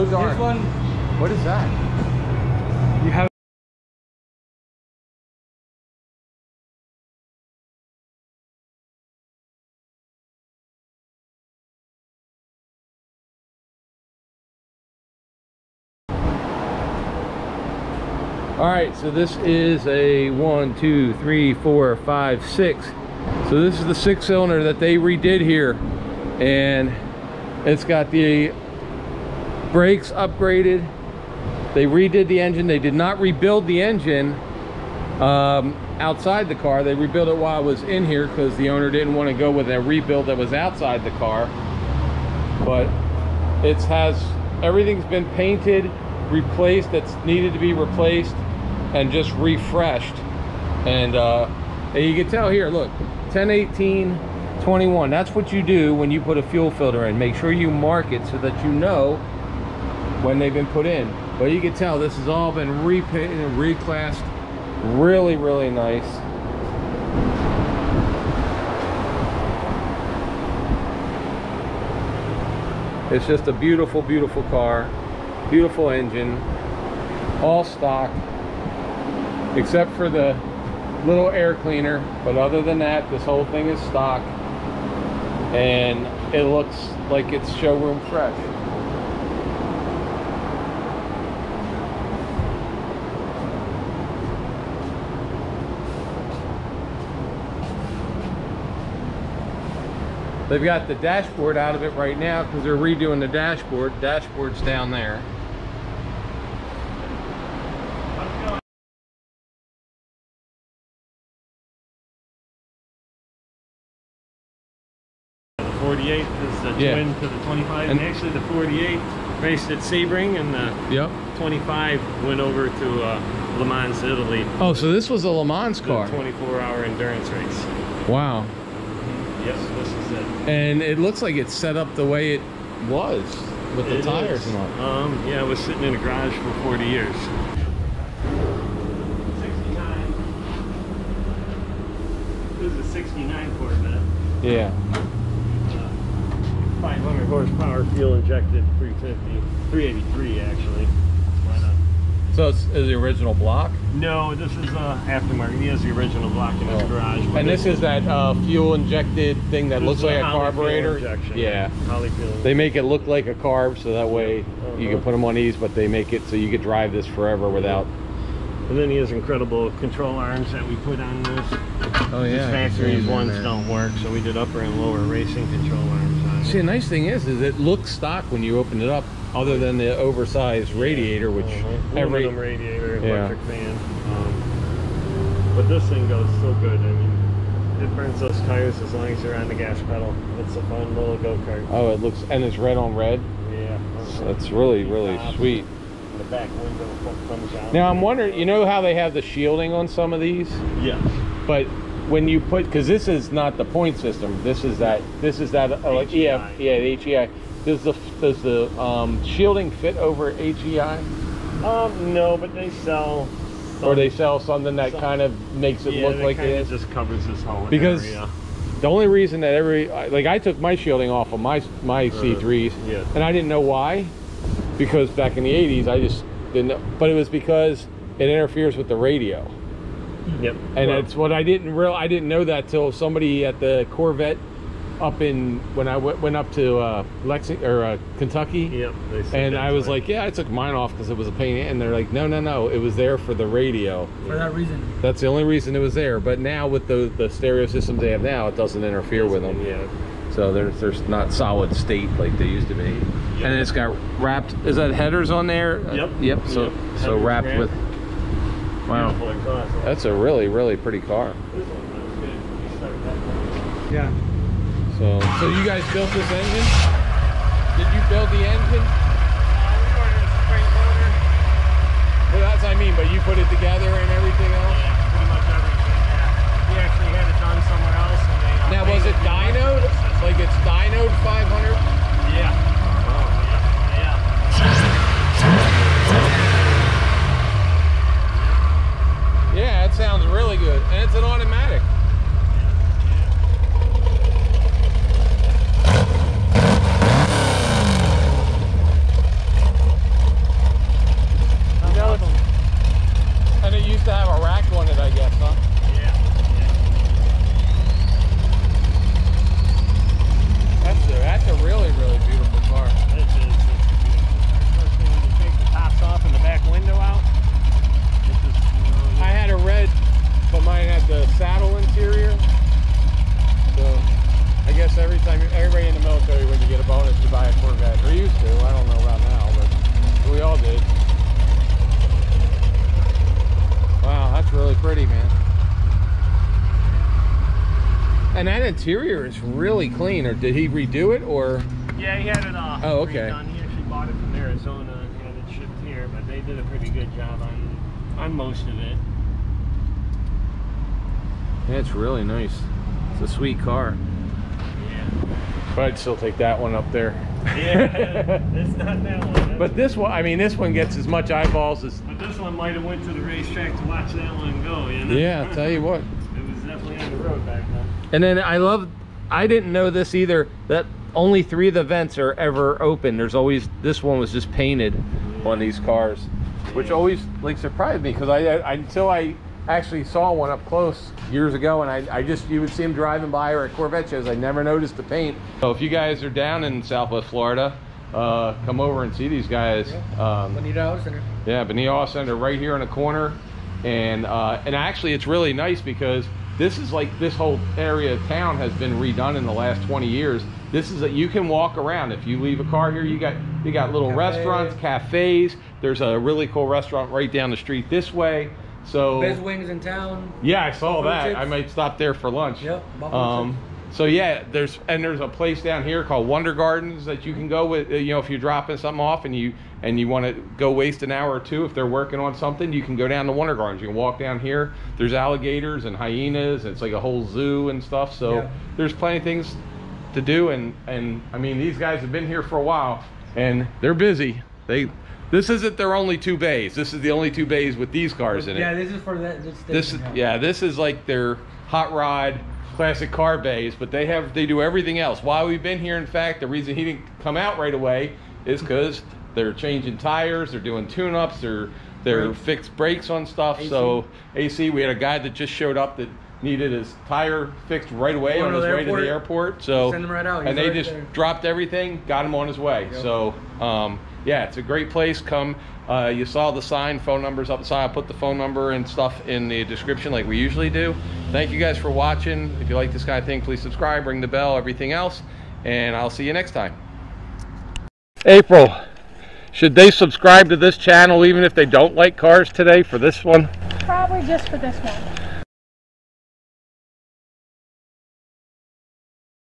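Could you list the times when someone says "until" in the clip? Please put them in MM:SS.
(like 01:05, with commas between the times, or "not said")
06:18.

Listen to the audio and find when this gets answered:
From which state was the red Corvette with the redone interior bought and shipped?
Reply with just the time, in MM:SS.
05:44.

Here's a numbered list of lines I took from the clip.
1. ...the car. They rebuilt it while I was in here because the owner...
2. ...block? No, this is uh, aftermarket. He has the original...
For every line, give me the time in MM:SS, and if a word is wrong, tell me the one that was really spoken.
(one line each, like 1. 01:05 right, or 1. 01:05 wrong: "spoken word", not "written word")
1. 00:36 right
2. 02:33 right.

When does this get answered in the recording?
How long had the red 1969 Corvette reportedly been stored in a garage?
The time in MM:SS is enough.
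02:16.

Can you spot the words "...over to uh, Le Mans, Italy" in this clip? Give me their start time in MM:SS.
02:02.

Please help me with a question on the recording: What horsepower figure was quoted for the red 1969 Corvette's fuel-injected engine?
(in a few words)
500.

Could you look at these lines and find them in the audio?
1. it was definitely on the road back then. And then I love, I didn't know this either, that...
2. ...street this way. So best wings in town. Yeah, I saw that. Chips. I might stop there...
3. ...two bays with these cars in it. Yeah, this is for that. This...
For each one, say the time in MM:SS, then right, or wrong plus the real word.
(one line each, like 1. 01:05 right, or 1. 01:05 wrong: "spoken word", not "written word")
1. 06:06 right
2. 06:47 right
3. 07:17 right.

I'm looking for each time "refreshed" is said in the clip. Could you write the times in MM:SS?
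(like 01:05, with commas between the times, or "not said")
00:49.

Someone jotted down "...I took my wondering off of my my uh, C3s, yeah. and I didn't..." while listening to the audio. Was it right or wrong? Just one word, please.
wrong.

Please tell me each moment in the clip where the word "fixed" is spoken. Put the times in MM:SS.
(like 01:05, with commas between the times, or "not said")
07:32, 07:37.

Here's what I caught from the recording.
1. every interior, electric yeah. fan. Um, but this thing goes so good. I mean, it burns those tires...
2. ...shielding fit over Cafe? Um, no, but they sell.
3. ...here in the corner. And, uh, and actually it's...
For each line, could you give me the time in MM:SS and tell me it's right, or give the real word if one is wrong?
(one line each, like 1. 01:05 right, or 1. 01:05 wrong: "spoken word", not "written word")
1. 03:01 wrong: "radiator", not "interior"
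2. 03:29 wrong: "HEI", not "Cafe"
3. 06:32 right.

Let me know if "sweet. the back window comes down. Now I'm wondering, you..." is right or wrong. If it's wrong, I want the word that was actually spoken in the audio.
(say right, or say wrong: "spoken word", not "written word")
right.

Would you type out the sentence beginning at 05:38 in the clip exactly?
And that interior is really clean.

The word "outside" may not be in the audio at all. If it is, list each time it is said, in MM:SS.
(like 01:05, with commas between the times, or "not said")
00:35, 00:40.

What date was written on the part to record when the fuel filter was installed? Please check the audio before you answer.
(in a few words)
10/18/21.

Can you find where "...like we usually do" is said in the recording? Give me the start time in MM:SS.
07:50.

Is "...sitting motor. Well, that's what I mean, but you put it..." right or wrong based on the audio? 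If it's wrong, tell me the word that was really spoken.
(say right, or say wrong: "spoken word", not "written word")
wrong: "spring", not "sitting".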